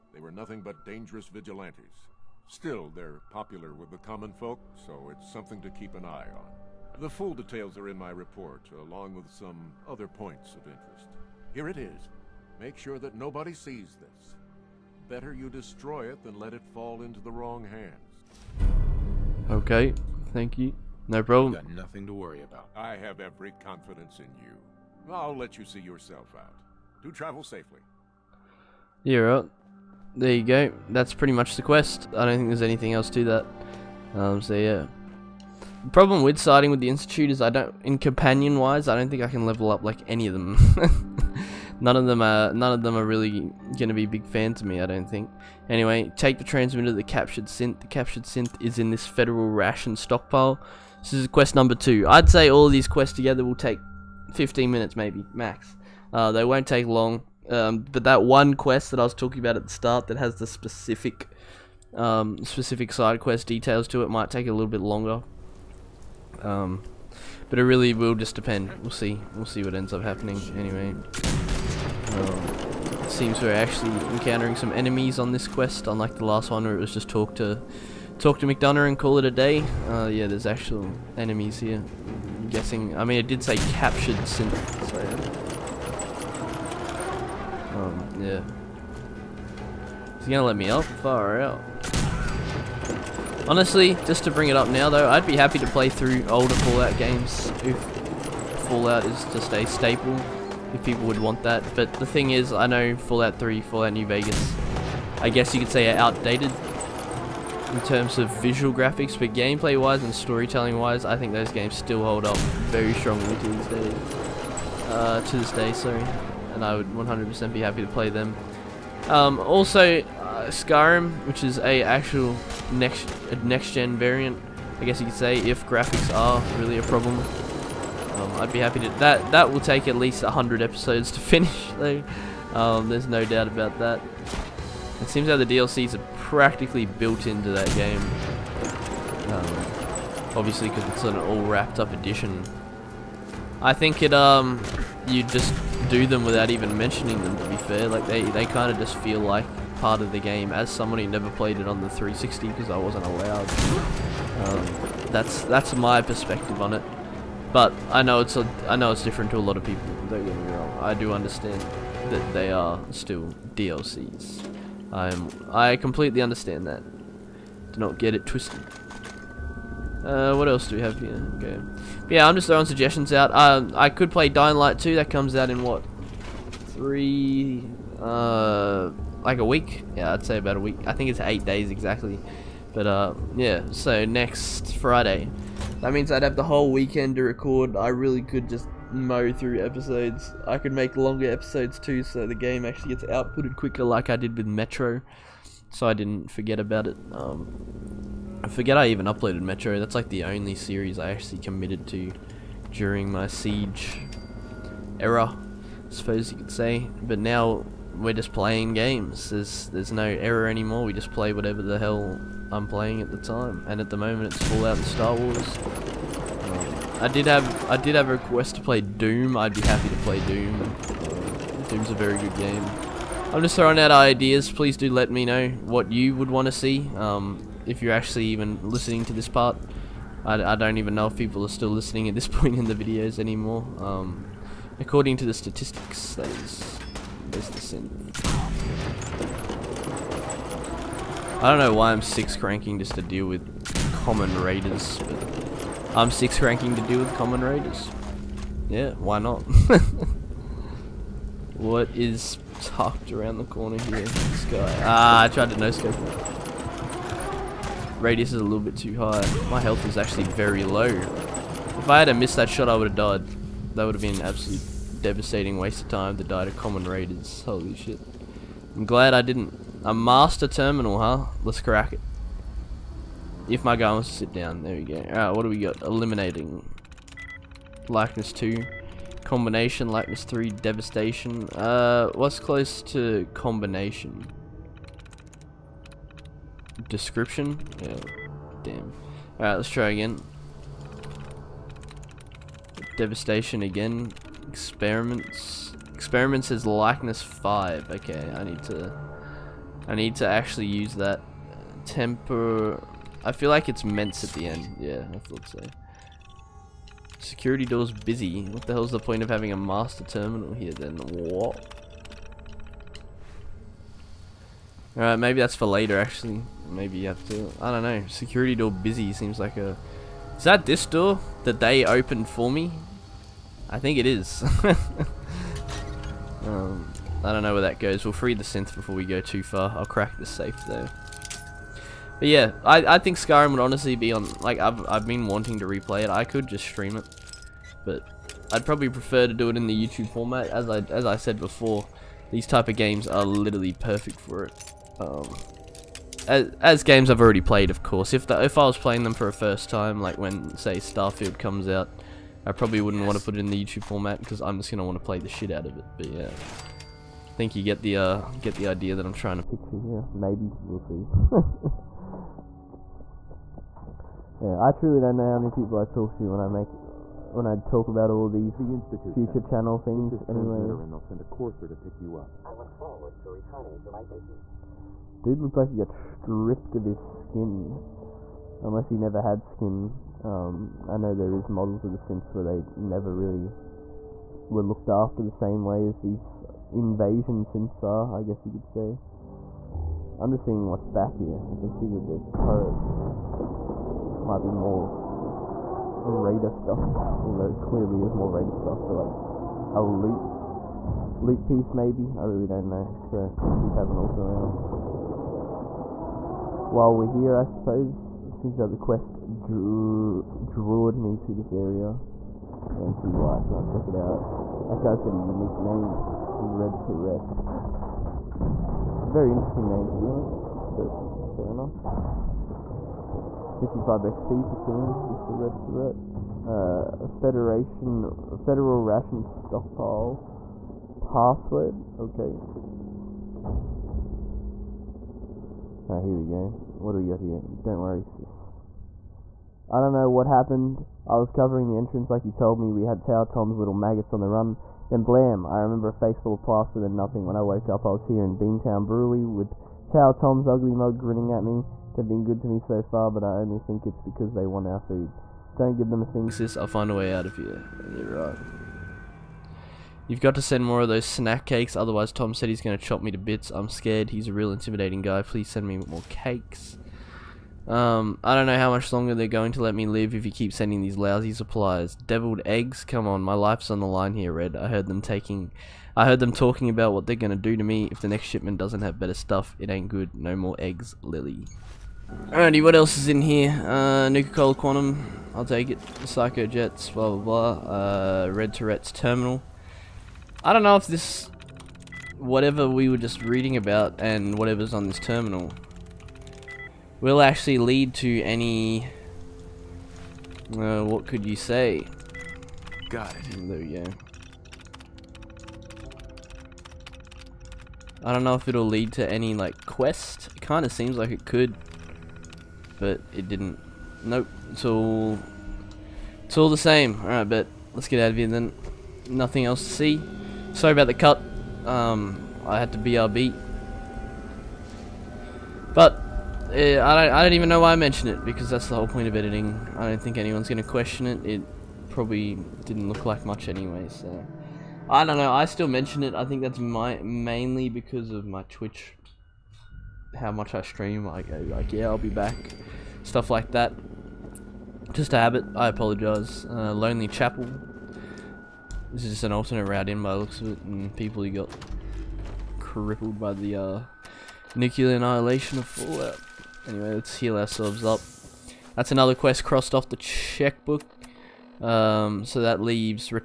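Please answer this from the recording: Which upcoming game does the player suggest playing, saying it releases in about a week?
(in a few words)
Dying Light 2.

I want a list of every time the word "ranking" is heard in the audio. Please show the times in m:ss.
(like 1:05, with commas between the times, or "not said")
4:02, 4:06.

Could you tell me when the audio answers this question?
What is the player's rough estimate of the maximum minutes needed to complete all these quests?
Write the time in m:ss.
0:54.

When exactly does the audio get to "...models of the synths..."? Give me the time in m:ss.
6:21.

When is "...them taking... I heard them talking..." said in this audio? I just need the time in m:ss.
7:54.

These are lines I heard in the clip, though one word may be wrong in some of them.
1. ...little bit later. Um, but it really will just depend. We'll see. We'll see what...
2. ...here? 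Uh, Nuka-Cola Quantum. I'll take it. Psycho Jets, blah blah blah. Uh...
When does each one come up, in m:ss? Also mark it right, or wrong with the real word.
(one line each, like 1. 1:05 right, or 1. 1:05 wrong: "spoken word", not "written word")
1. 1:04 wrong: "longer", not "later"
2. 8:03 right.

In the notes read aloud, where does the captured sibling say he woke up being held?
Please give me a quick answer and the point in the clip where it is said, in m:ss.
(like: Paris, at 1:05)
Beantown Brewery, at 7:28.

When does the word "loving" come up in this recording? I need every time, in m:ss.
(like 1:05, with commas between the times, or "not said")
not said.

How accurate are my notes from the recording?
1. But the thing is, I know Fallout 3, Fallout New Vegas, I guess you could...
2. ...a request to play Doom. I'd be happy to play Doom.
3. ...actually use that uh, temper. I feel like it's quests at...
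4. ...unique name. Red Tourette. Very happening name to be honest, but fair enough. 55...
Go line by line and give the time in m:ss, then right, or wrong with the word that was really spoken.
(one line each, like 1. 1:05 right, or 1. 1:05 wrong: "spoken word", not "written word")
1. 1:41 right
2. 3:38 right
3. 5:00 wrong: "mints", not "quests"
4. 6:55 wrong: "interesting", not "happening".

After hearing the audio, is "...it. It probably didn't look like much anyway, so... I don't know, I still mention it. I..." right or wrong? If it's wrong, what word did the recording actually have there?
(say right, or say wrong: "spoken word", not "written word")
right.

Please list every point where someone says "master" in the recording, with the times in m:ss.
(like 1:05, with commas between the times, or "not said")
4:29, 5:09.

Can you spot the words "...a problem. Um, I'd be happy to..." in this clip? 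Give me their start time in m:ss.
2:06.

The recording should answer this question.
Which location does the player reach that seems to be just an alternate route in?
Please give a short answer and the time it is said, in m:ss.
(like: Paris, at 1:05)
Lonely Chapel, at 9:06.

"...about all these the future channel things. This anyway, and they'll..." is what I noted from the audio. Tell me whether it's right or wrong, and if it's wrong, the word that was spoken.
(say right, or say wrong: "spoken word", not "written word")
right.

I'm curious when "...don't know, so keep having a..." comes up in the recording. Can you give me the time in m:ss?
6:42.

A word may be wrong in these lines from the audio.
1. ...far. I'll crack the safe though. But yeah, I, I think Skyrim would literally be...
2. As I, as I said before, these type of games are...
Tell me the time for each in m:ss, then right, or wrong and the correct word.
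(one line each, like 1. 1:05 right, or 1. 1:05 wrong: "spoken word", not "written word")
1. 5:29 wrong: "honestly", not "literally"
2. 5:40 right.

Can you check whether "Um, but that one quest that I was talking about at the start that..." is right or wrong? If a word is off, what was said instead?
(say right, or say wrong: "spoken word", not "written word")
right.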